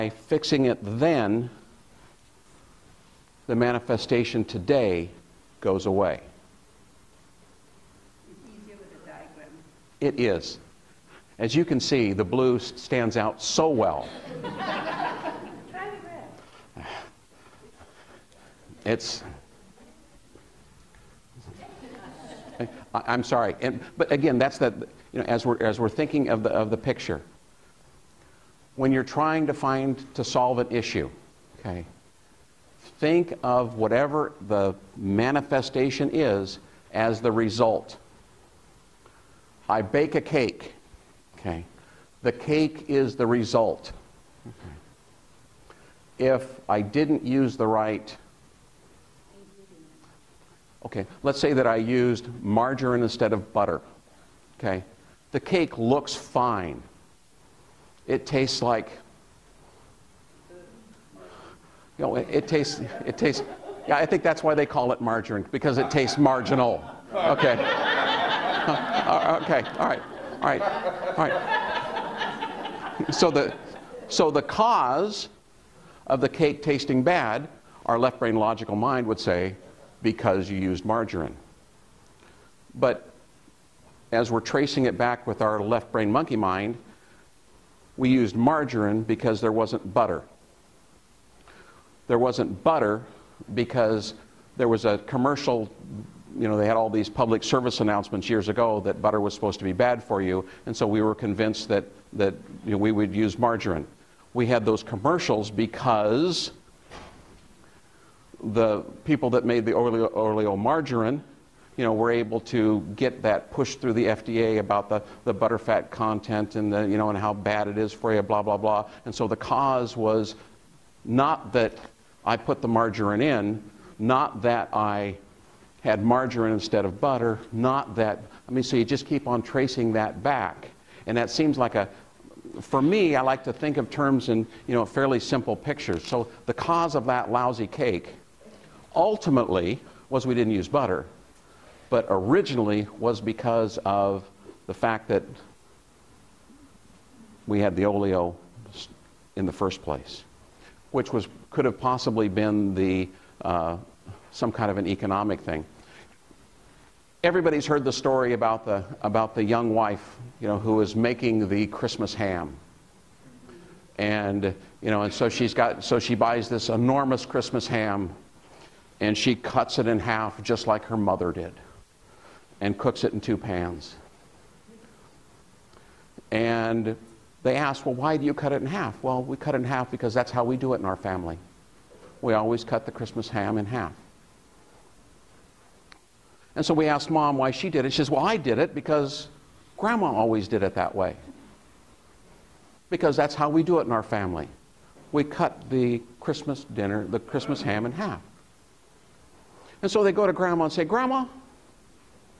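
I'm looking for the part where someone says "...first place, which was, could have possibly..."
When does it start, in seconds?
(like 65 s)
149 s.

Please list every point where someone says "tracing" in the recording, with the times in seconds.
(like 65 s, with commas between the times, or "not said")
84 s, 129 s.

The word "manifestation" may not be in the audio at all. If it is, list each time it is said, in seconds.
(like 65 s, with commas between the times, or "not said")
3 s, 34 s.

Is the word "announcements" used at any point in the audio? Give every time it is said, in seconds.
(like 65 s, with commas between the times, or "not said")
97 s.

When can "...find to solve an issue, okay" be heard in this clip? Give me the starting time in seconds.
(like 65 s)
29 s.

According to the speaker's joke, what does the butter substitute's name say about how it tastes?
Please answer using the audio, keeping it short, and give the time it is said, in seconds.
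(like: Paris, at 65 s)
marginal, at 66 s.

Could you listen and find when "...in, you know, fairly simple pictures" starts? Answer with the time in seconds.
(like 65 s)
134 s.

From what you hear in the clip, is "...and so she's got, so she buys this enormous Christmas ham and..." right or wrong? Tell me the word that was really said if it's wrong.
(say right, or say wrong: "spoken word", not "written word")
right.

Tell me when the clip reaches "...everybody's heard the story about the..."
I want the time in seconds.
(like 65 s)
157 s.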